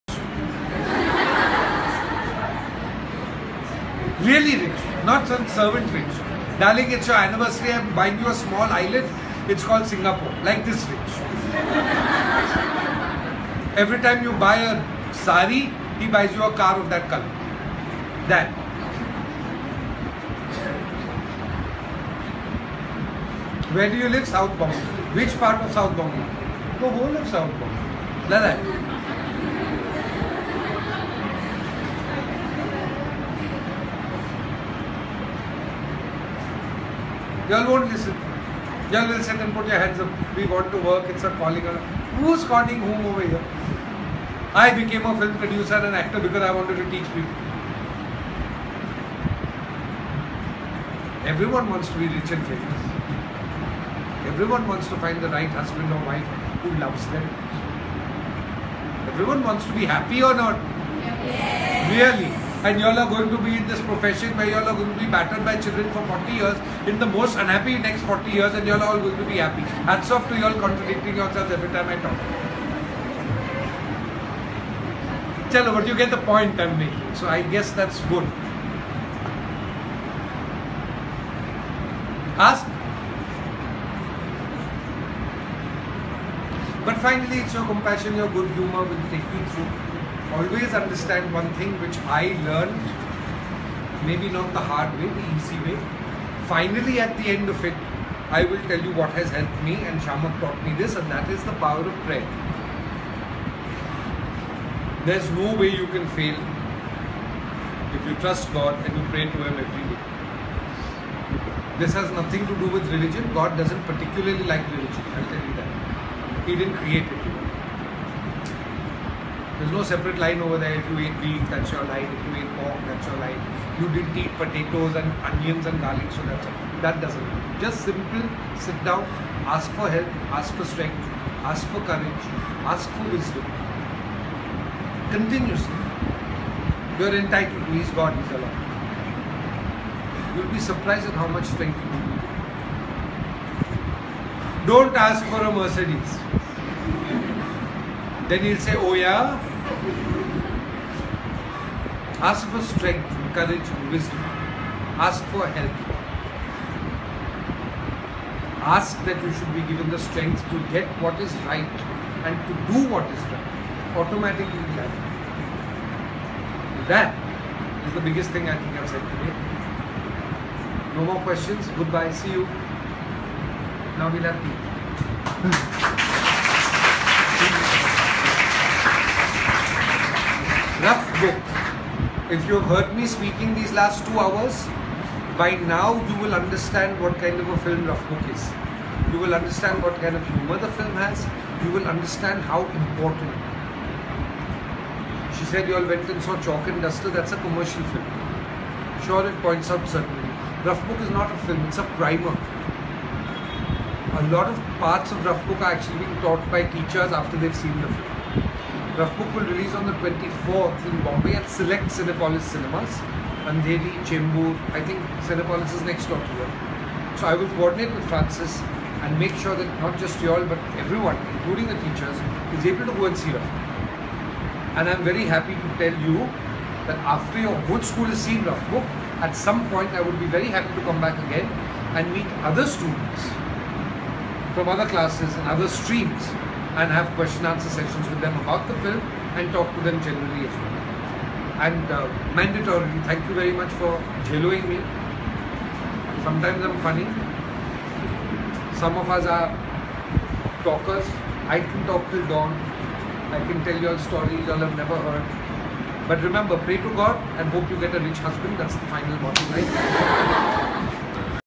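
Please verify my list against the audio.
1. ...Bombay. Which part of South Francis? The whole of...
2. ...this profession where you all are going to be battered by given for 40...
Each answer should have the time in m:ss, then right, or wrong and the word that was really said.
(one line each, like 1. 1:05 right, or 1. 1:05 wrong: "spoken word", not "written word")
1. 0:24 wrong: "Bombay", not "Francis"
2. 1:03 wrong: "children", not "given".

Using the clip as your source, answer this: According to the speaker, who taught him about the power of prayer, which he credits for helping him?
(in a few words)
Shamak.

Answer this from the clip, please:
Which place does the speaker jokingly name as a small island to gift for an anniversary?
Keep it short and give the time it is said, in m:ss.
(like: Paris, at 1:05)
Singapore, at 0:09.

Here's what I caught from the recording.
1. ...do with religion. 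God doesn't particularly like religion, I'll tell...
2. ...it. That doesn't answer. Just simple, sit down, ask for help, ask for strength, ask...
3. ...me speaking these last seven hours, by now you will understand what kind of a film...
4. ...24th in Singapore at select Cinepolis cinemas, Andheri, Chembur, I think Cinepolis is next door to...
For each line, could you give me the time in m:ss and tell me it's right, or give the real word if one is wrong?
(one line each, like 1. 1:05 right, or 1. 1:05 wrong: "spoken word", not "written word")
1. 1:52 right
2. 2:06 wrong: "matter", not "answer"
3. 3:02 wrong: "two", not "seven"
4. 3:29 wrong: "Bombay", not "Singapore".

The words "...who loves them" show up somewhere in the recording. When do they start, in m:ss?
0:56.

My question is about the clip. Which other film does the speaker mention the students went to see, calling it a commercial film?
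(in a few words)
Chalk and Duster.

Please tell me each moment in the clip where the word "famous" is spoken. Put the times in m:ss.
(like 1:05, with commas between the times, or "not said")
0:52.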